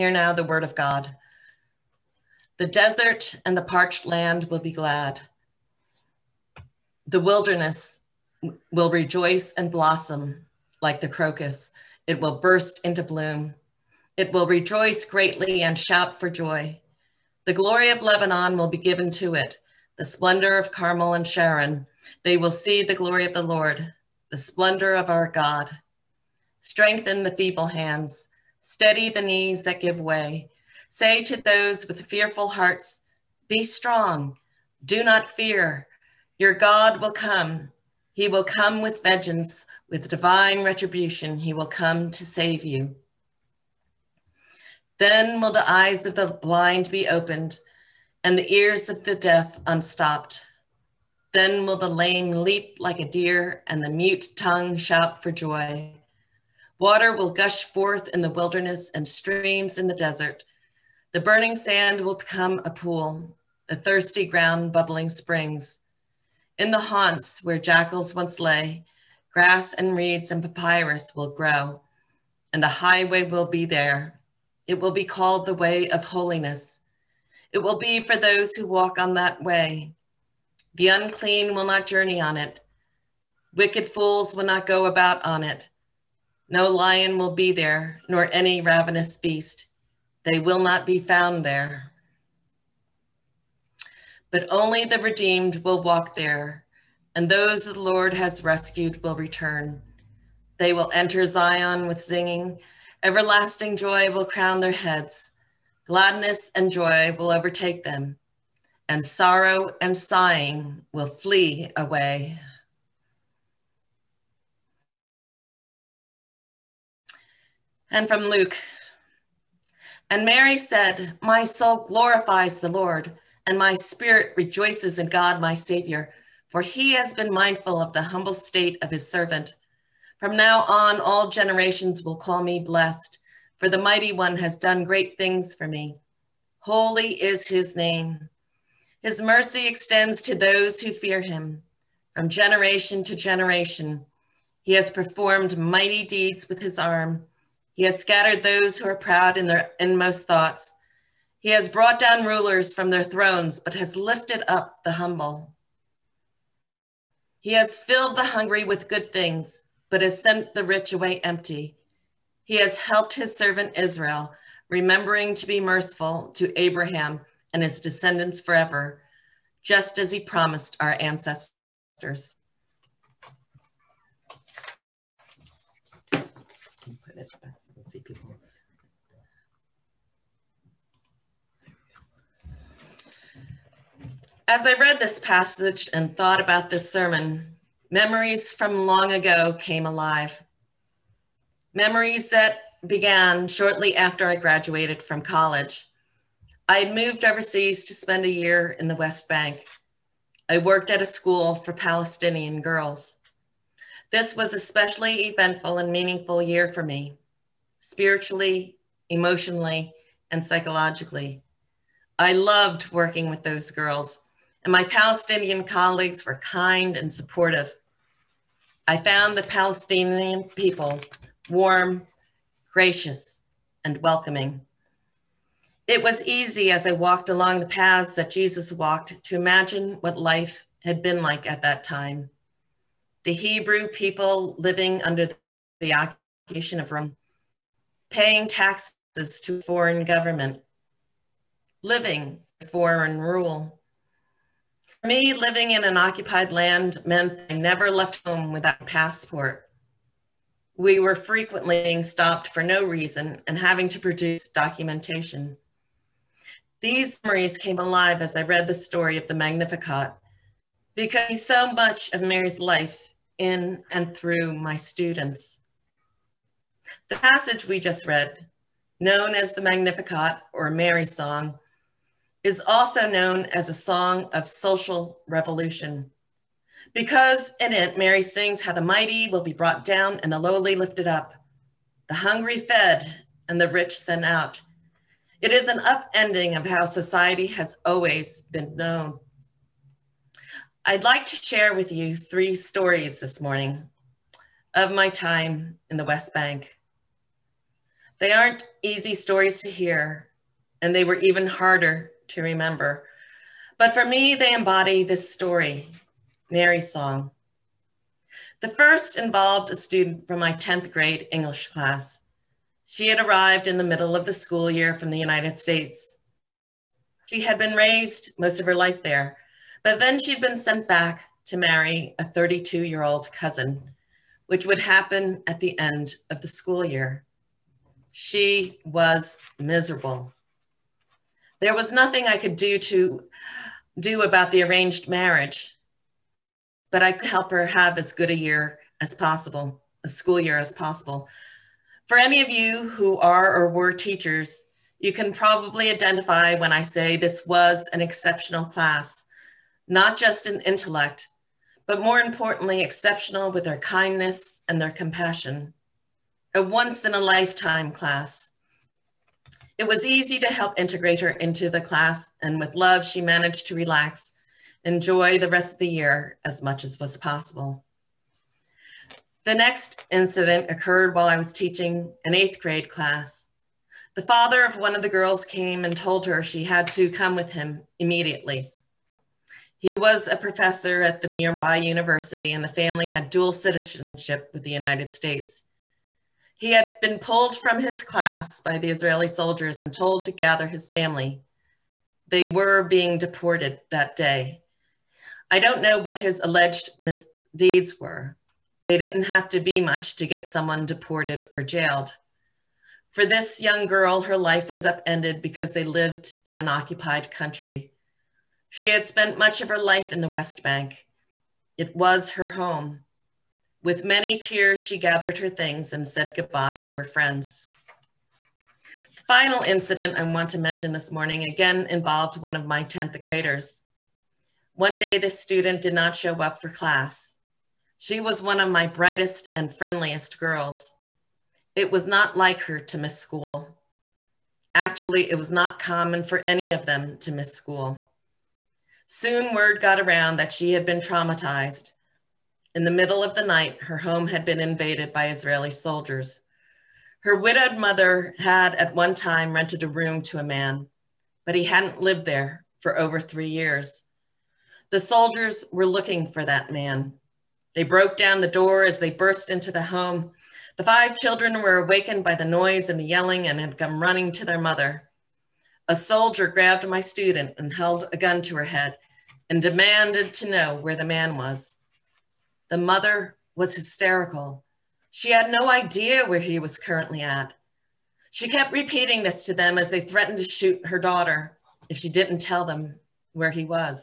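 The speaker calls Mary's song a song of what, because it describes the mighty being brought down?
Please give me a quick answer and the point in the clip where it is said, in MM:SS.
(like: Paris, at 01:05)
Social revolution, at 04:34.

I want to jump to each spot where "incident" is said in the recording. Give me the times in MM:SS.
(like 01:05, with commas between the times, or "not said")
06:10, 06:59.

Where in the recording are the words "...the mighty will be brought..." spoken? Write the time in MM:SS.
04:38.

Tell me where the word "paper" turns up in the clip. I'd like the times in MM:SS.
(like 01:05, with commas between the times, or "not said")
not said.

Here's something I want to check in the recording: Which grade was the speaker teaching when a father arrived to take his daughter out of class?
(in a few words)
8th grade.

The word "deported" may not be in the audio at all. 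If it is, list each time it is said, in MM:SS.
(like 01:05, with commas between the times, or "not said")
06:33, 06:40.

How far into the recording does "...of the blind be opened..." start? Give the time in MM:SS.
00:46.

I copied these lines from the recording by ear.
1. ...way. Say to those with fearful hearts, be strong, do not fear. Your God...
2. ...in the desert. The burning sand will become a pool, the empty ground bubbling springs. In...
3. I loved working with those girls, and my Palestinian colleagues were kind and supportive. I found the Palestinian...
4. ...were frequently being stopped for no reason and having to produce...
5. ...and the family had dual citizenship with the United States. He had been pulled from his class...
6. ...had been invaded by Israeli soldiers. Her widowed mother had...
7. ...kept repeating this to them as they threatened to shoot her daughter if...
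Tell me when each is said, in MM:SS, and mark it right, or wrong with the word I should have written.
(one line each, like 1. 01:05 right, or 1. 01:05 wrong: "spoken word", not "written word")
1. 00:29 right
2. 00:59 wrong: "thirsty", not "empty"
3. 03:32 right
4. 04:10 right
5. 06:22 right
6. 07:24 right
7. 07:58 right.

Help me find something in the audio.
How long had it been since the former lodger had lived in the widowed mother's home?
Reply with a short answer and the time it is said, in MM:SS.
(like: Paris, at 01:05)
Over 3 years, at 07:32.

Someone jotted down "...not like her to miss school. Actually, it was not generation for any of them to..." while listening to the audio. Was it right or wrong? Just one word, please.
wrong.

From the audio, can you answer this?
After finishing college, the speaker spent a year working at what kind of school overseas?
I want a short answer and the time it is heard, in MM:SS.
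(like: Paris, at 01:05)
A school for Palestinian girls, at 03:21.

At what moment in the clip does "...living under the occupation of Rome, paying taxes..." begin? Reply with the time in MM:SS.
03:54.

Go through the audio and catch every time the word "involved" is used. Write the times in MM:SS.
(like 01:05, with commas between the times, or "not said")
05:09, 07:01.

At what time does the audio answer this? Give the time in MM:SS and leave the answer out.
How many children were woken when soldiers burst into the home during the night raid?
07:40.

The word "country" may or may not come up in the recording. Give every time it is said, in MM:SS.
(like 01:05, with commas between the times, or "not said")
06:47.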